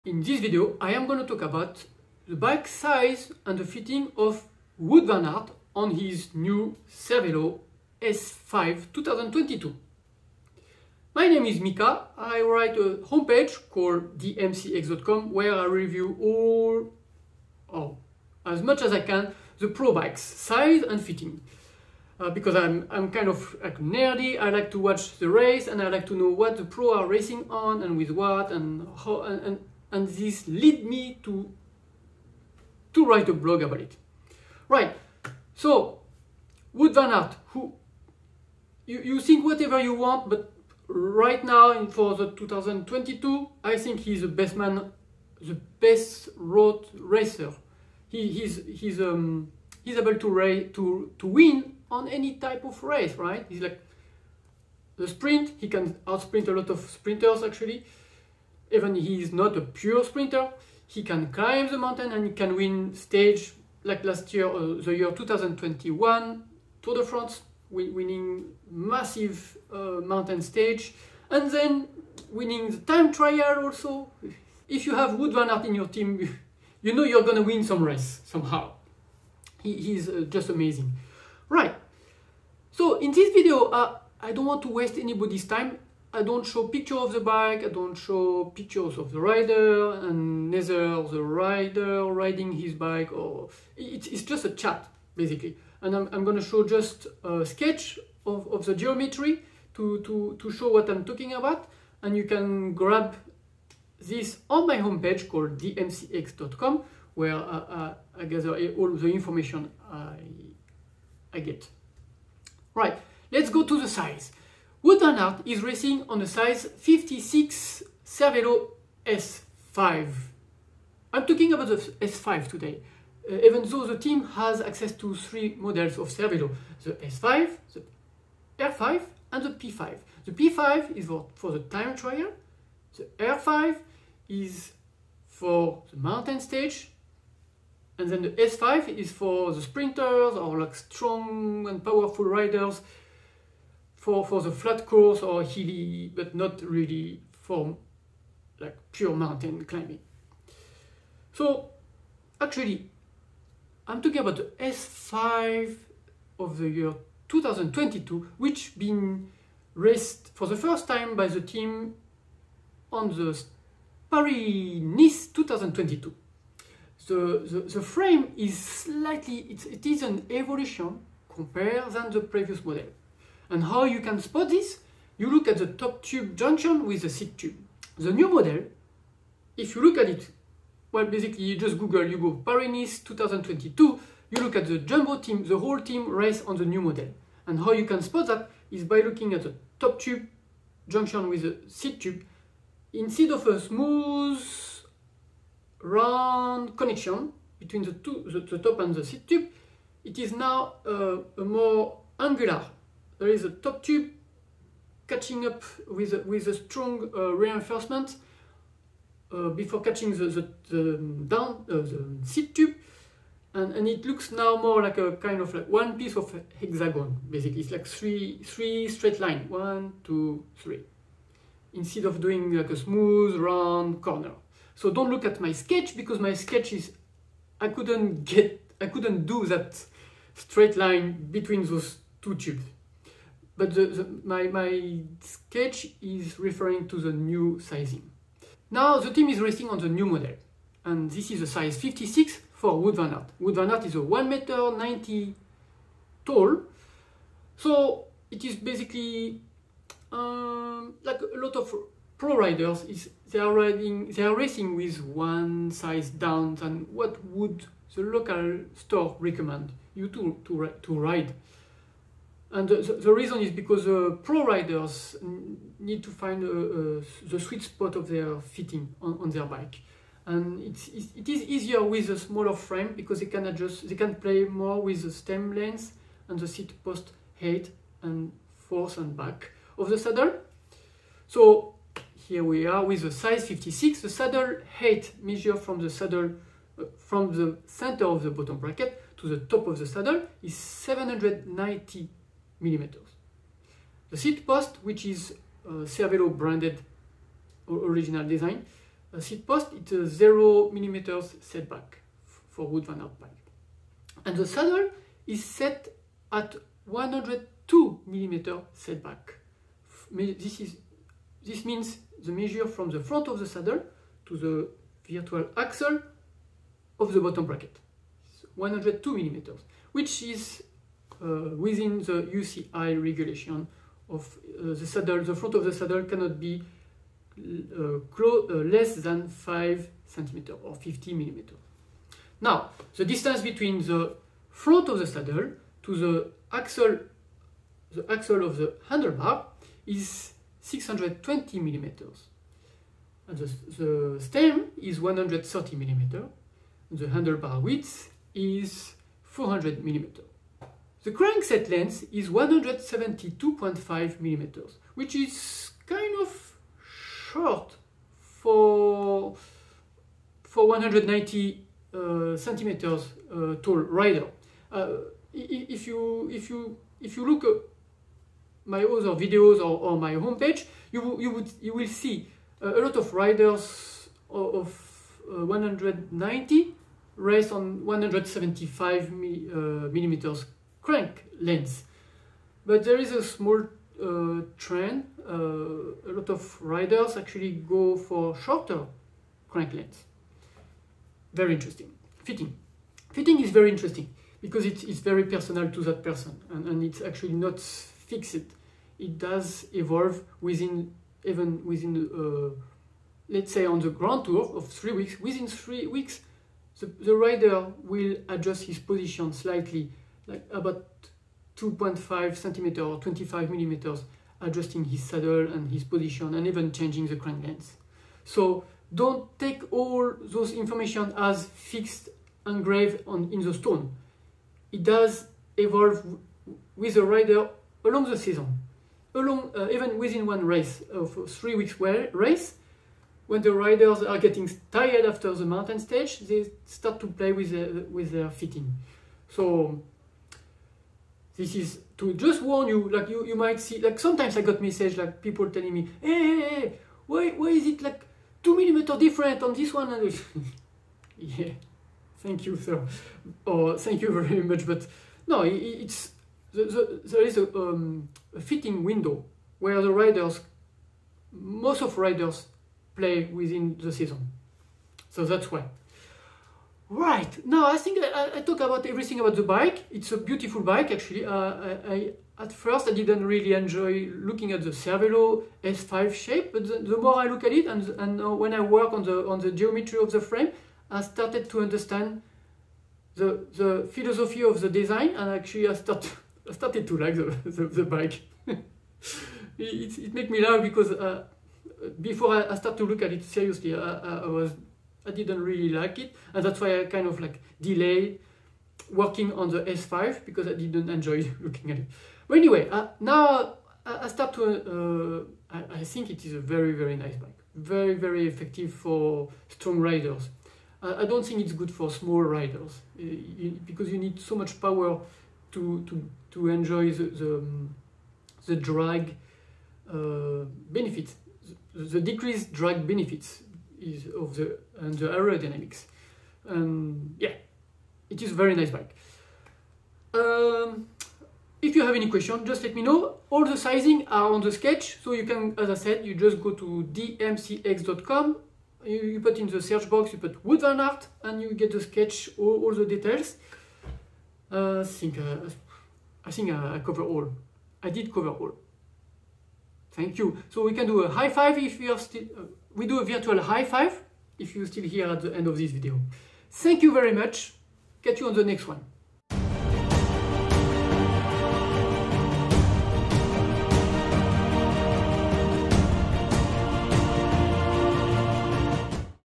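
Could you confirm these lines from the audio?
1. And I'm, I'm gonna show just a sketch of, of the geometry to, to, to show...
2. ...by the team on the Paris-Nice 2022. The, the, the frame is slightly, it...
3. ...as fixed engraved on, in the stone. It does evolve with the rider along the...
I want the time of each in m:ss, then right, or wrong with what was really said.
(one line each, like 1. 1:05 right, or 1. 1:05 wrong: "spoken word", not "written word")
1. 1:35 right
2. 2:41 right
3. 7:01 right.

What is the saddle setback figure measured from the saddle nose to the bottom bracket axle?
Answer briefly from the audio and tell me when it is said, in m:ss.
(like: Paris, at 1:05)
102 mm, at 5:06.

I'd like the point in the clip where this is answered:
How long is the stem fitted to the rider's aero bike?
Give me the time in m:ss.
5:44.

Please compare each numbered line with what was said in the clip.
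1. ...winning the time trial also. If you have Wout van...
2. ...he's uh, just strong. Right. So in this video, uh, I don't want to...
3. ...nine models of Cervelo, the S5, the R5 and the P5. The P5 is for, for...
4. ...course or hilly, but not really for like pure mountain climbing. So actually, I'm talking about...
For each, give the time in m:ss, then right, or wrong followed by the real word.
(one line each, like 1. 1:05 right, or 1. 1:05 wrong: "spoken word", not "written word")
1. 1:12 right
2. 1:19 wrong: "amazing", not "strong"
3. 2:05 wrong: "three", not "nine"
4. 2:24 right.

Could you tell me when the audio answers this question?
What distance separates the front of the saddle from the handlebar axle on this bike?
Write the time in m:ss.
5:40.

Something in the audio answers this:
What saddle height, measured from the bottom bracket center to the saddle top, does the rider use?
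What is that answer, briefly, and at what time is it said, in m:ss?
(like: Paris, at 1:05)
790 mm, at 4:50.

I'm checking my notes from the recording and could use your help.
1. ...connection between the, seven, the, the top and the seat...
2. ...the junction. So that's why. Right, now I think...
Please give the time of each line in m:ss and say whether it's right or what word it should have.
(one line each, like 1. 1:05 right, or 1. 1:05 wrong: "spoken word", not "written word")
1. 3:16 wrong: "two", not "seven"
2. 7:43 wrong: "season", not "junction".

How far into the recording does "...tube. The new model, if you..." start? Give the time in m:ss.
2:57.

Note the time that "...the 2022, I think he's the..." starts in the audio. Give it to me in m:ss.
0:42.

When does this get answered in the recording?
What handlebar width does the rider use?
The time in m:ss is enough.
5:49.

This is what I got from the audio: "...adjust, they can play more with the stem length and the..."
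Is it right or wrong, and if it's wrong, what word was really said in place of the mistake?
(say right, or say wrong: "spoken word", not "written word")
right.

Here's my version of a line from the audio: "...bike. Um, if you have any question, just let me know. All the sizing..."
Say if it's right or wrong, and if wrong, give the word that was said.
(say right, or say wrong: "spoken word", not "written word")
right.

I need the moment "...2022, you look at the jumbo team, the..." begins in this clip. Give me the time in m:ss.
3:02.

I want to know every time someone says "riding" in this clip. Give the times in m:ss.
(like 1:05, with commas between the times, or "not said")
1:32, 4:13.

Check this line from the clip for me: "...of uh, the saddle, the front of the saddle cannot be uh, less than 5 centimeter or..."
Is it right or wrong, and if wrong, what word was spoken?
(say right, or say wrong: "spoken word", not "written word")
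right.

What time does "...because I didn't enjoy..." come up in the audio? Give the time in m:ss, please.
8:20.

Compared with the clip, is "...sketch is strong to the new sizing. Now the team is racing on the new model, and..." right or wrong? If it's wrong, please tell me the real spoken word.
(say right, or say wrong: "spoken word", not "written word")
wrong: "referring", not "strong".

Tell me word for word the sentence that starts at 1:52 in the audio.
Right, let's go to the size.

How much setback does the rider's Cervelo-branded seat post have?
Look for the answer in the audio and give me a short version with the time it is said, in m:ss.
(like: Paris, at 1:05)
0 mm, at 5:00.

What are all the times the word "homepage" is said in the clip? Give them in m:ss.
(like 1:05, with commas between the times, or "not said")
0:13, 1:44, 6:10.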